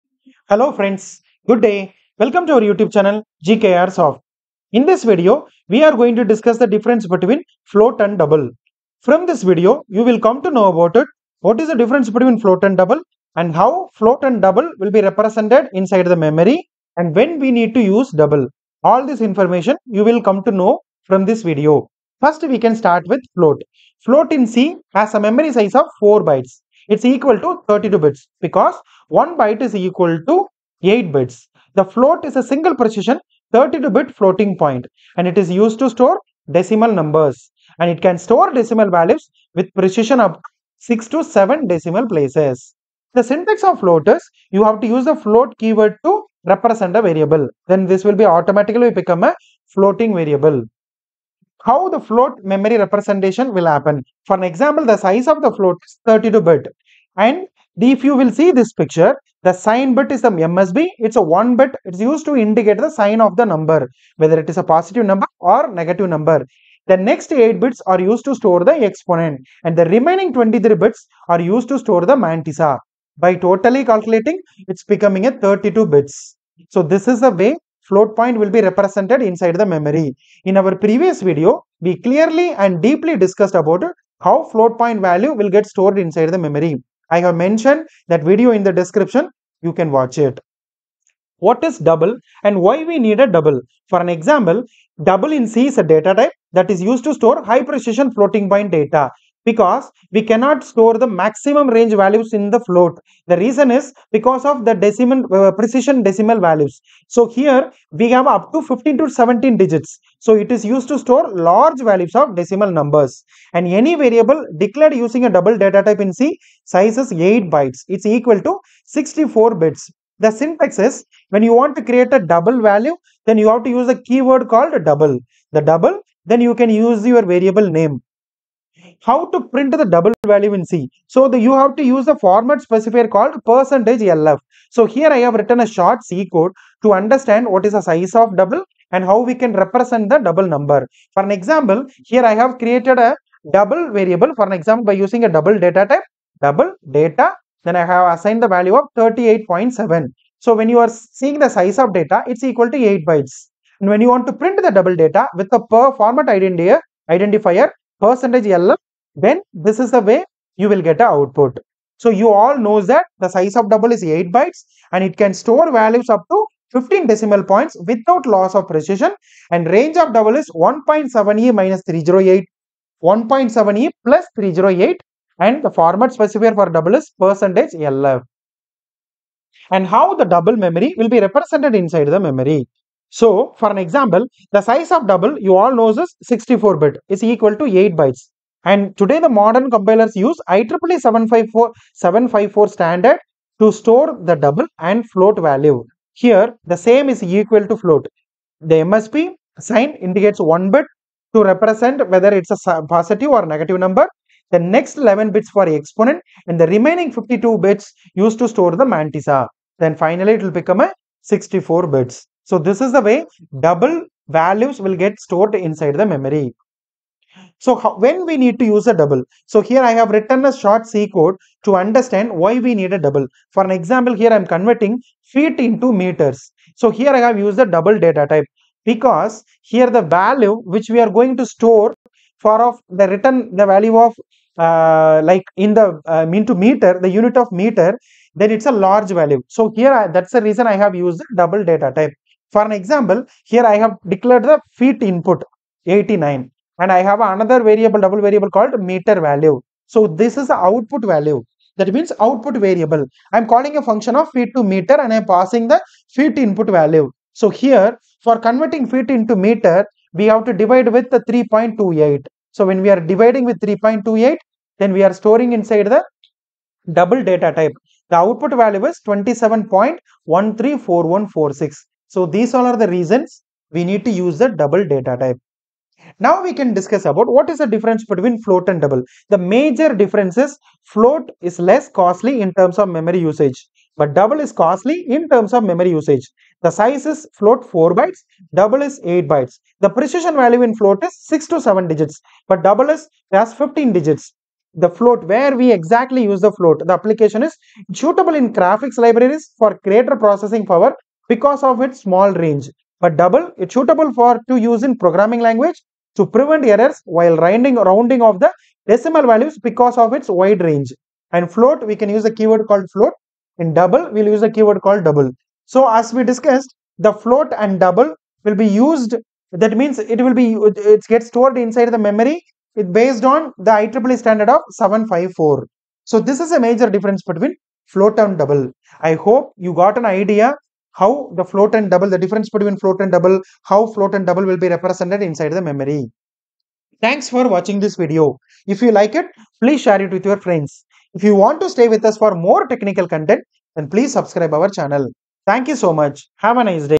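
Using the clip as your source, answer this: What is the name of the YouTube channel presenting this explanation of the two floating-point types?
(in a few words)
GKR Soft.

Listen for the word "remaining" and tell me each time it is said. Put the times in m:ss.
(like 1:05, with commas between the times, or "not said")
1:09, 3:26.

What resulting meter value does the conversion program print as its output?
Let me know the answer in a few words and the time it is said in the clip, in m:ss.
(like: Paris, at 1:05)
27.134146, at 4:29.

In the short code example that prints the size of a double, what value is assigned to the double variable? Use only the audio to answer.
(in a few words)
38.7.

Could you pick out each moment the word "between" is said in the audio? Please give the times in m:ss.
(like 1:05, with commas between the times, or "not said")
0:07, 0:12, 4:38, 5:27, 5:32.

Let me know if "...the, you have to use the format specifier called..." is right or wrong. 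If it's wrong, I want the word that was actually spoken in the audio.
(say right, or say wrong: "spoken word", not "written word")
right.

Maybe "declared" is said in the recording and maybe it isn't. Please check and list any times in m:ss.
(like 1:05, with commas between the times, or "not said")
1:54, 4:04.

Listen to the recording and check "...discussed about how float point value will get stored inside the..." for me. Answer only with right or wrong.
right.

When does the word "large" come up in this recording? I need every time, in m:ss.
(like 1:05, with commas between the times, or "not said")
1:51, 3:58.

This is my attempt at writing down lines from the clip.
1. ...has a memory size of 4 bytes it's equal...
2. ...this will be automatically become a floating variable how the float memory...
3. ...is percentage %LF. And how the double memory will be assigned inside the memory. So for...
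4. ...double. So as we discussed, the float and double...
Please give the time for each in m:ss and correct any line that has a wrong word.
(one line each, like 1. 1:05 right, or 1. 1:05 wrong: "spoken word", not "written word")
1. 0:24 right
2. 0:47 right
3. 2:56 wrong: "represented", not "assigned"
4. 5:15 right.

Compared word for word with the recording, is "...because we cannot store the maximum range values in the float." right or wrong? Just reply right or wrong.
right.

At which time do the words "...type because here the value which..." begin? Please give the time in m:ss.
3:48.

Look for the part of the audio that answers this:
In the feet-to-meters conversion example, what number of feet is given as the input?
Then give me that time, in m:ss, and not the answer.
4:05.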